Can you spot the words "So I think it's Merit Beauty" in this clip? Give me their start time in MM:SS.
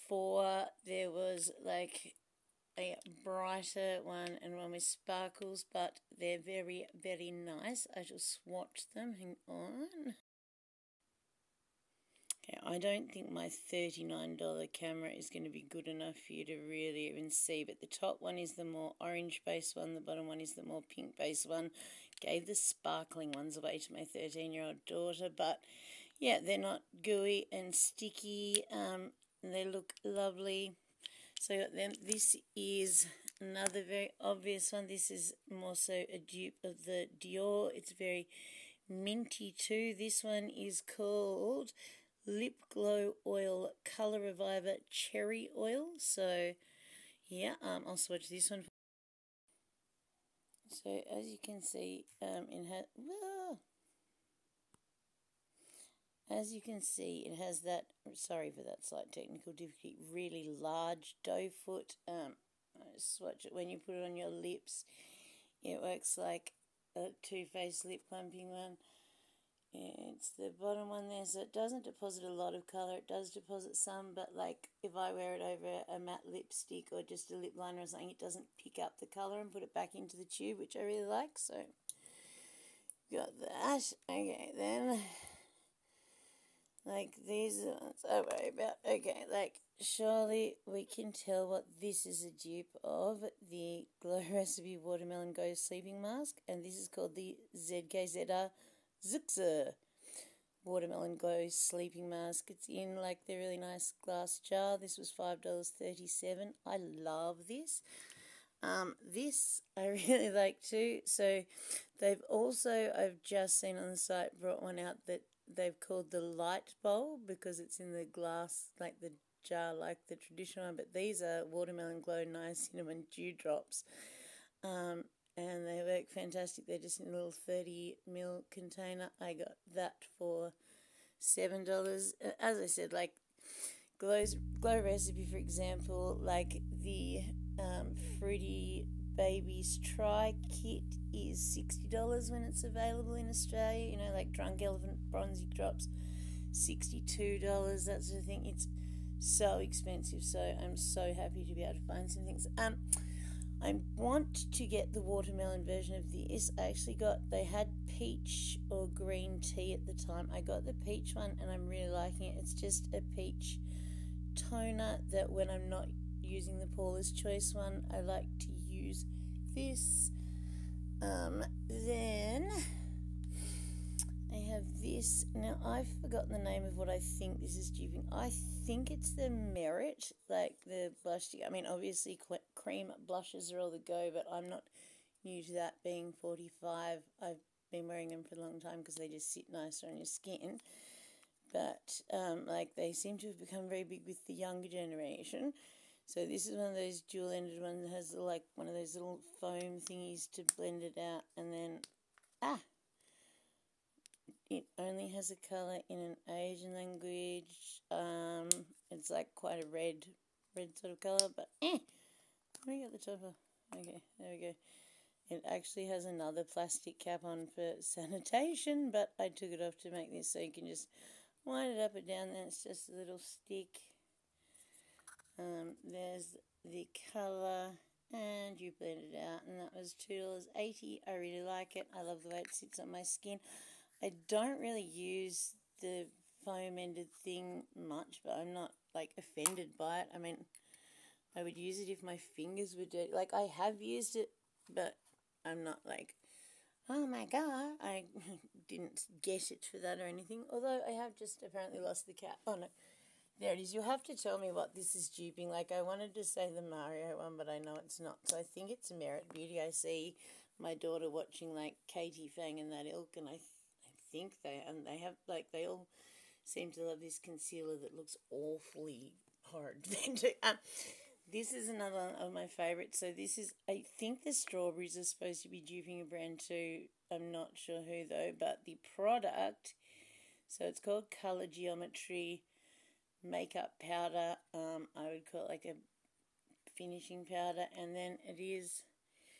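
04:18.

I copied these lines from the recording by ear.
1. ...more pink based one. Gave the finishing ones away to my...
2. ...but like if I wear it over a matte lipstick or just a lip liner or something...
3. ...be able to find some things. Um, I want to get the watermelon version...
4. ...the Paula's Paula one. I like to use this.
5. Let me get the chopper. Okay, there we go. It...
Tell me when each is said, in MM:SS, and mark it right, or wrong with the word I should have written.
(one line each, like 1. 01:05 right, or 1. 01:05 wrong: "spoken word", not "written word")
1. 00:20 wrong: "sparkling", not "finishing"
2. 01:14 right
3. 02:31 right
4. 02:46 wrong: "Choice", not "Paula"
5. 03:32 right.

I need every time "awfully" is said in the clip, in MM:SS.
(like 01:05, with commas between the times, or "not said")
04:28.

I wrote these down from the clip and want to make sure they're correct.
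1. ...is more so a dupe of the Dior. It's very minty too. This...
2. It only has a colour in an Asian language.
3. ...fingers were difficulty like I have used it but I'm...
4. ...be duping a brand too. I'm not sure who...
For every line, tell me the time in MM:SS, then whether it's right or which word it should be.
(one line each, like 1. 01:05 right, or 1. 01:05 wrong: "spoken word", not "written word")
1. 00:35 right
2. 03:24 right
3. 04:02 wrong: "dirty", not "difficulty"
4. 04:35 right.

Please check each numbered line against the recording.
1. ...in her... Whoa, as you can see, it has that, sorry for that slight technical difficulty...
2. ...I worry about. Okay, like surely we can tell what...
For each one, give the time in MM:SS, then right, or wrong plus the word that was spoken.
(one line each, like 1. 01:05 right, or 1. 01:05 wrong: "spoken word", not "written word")
1. 00:52 right
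2. 01:28 right.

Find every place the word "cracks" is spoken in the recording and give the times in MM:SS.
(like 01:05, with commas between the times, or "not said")
not said.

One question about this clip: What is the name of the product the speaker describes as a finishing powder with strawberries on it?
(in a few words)
Color Geometry makeup powder.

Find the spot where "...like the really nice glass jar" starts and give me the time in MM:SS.
01:42.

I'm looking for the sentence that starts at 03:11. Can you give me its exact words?
But um, like they seem to have become very big with the younger generation.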